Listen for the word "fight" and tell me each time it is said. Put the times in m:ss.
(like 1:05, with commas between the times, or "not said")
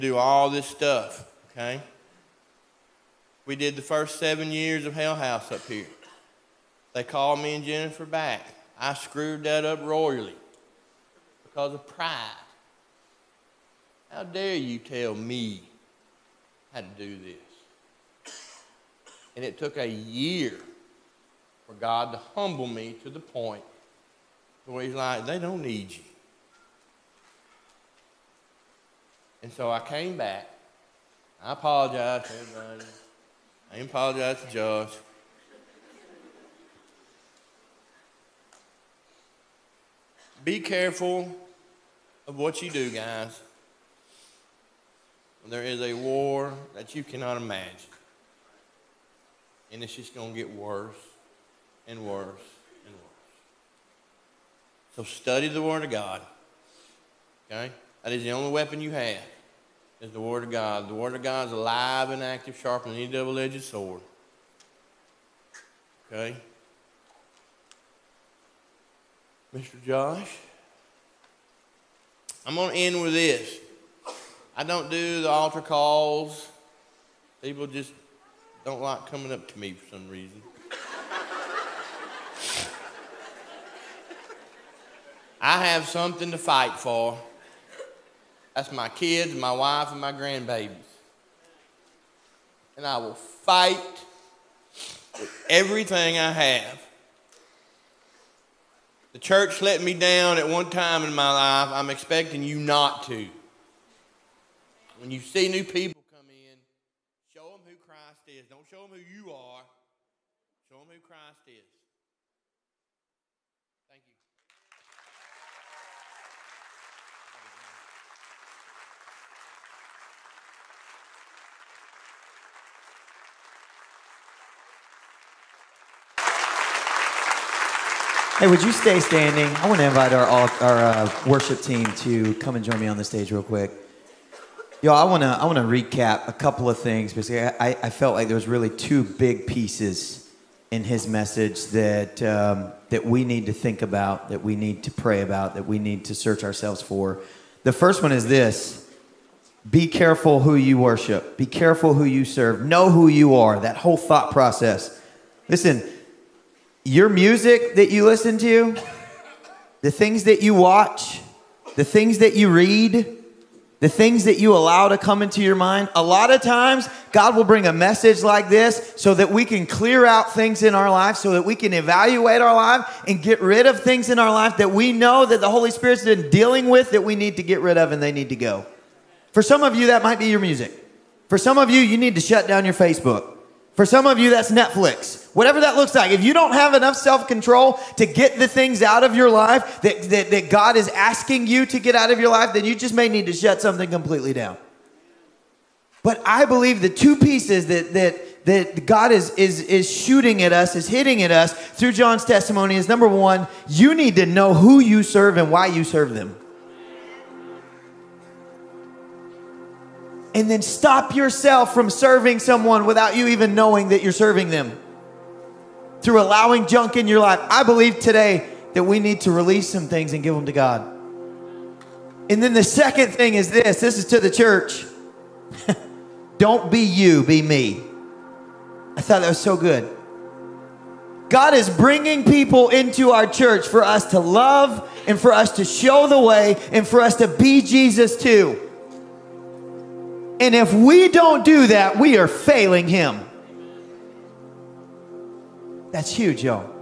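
1:26, 1:33.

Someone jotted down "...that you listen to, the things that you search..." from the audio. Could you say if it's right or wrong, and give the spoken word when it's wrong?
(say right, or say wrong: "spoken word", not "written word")
wrong: "watch", not "search".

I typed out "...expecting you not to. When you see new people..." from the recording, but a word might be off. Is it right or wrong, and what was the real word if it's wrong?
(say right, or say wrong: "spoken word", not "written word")
right.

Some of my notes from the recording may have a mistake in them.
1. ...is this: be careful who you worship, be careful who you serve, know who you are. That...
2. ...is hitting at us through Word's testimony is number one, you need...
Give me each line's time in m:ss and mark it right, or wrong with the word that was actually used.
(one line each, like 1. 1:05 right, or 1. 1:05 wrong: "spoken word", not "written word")
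1. 2:28 right
2. 3:20 wrong: "John", not "Word".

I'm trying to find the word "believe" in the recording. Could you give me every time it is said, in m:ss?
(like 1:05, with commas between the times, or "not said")
3:16, 3:37.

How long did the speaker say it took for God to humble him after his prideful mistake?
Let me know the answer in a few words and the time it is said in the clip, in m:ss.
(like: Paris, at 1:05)
A year, at 0:19.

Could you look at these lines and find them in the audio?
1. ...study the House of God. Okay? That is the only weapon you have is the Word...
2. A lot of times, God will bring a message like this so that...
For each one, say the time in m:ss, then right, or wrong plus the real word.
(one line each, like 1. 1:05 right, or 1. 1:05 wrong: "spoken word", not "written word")
1. 0:55 wrong: "Word", not "House"
2. 2:45 right.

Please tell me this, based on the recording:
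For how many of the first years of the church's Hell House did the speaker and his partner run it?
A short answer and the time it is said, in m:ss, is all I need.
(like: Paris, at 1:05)
7, at 0:04.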